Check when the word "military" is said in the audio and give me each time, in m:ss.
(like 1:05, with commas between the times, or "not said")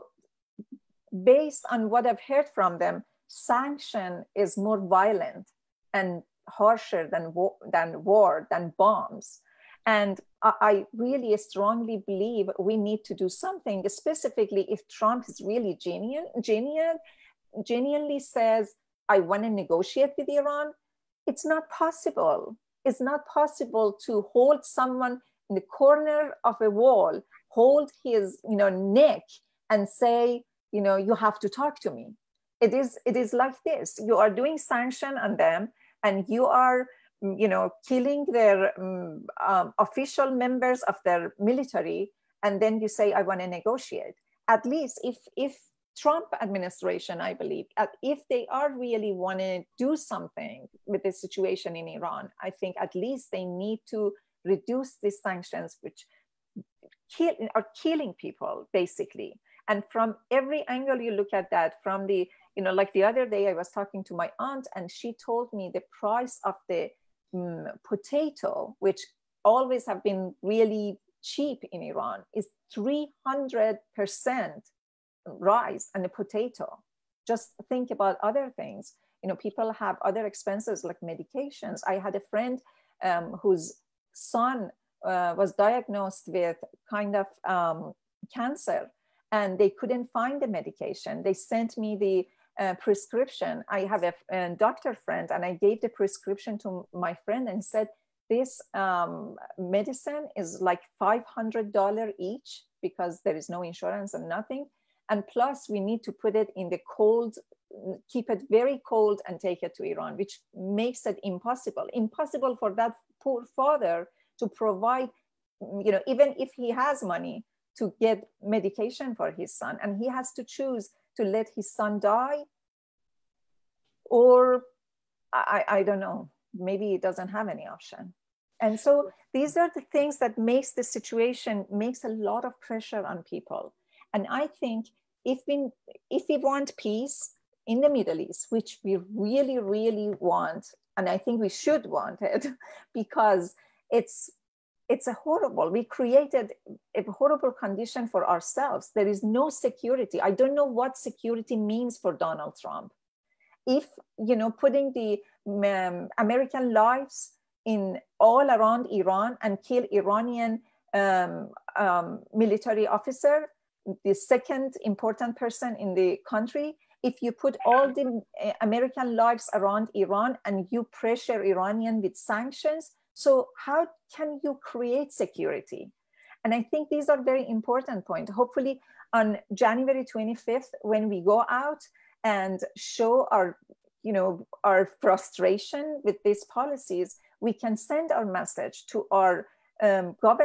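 0:41, 2:42.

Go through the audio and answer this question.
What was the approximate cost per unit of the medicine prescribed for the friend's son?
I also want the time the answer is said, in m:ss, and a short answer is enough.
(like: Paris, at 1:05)
$500, at 1:40.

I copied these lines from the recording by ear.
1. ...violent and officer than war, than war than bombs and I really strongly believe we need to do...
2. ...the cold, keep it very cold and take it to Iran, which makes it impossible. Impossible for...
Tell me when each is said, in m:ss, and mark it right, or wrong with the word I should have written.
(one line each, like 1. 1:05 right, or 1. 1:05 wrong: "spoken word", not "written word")
1. 0:04 wrong: "harsher", not "officer"
2. 1:46 right.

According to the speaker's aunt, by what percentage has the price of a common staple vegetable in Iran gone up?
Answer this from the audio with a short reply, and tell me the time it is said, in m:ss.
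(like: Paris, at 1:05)
300 percent, at 1:12.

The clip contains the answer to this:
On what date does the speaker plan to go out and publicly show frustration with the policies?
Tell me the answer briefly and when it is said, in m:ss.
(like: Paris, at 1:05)
January 25th, at 2:59.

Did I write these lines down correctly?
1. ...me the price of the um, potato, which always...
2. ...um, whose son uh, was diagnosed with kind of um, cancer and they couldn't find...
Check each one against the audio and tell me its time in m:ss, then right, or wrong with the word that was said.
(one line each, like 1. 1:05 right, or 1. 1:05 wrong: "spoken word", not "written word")
1. 1:05 right
2. 1:23 right.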